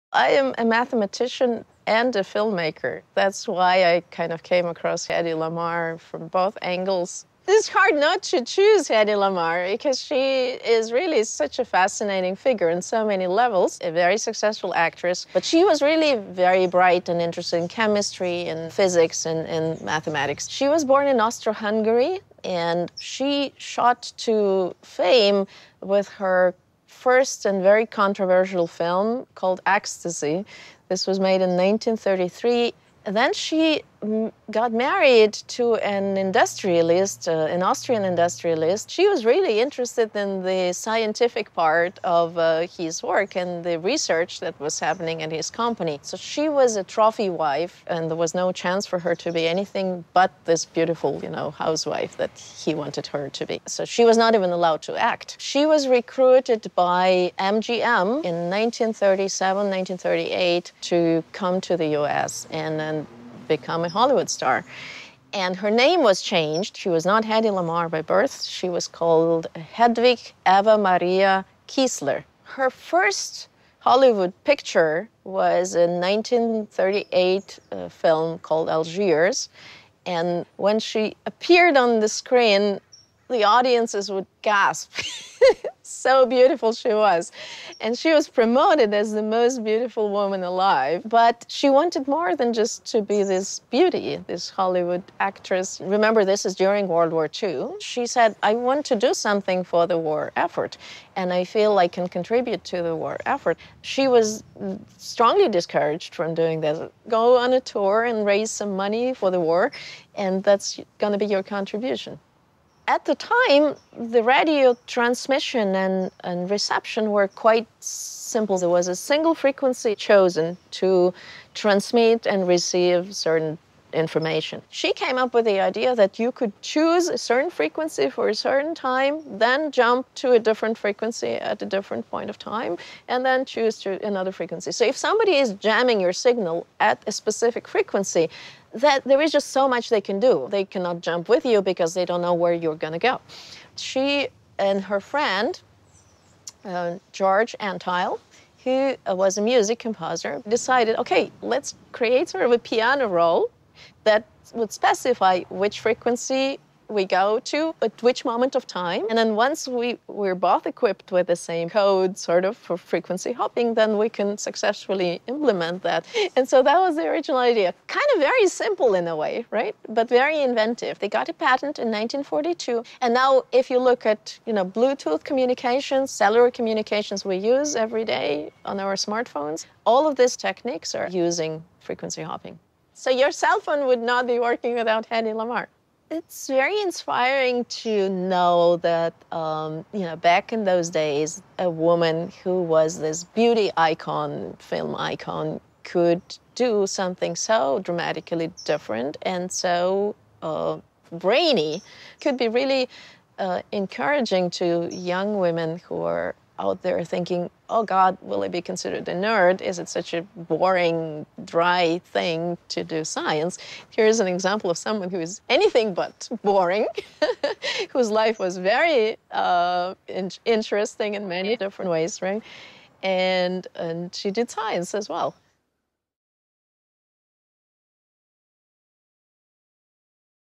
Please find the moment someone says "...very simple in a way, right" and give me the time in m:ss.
2:48.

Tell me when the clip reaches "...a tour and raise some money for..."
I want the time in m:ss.
1:47.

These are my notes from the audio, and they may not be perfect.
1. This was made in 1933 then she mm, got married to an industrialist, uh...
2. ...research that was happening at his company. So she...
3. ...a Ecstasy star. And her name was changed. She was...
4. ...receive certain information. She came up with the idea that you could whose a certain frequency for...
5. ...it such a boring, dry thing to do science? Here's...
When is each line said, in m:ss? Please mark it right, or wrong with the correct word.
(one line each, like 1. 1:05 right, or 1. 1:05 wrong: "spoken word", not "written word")
1. 0:30 right
2. 0:43 right
3. 1:03 wrong: "Hollywood", not "Ecstasy"
4. 2:02 wrong: "choose", not "whose"
5. 3:29 right.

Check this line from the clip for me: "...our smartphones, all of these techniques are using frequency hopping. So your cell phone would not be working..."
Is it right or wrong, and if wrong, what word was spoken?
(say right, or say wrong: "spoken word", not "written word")
right.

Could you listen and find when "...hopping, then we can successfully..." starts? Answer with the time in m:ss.
2:43.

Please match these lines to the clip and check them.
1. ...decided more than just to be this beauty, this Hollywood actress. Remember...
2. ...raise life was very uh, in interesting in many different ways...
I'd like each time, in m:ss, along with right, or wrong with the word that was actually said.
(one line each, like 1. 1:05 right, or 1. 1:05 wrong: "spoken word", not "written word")
1. 1:31 wrong: "wanted", not "decided"
2. 3:37 wrong: "whose", not "raise".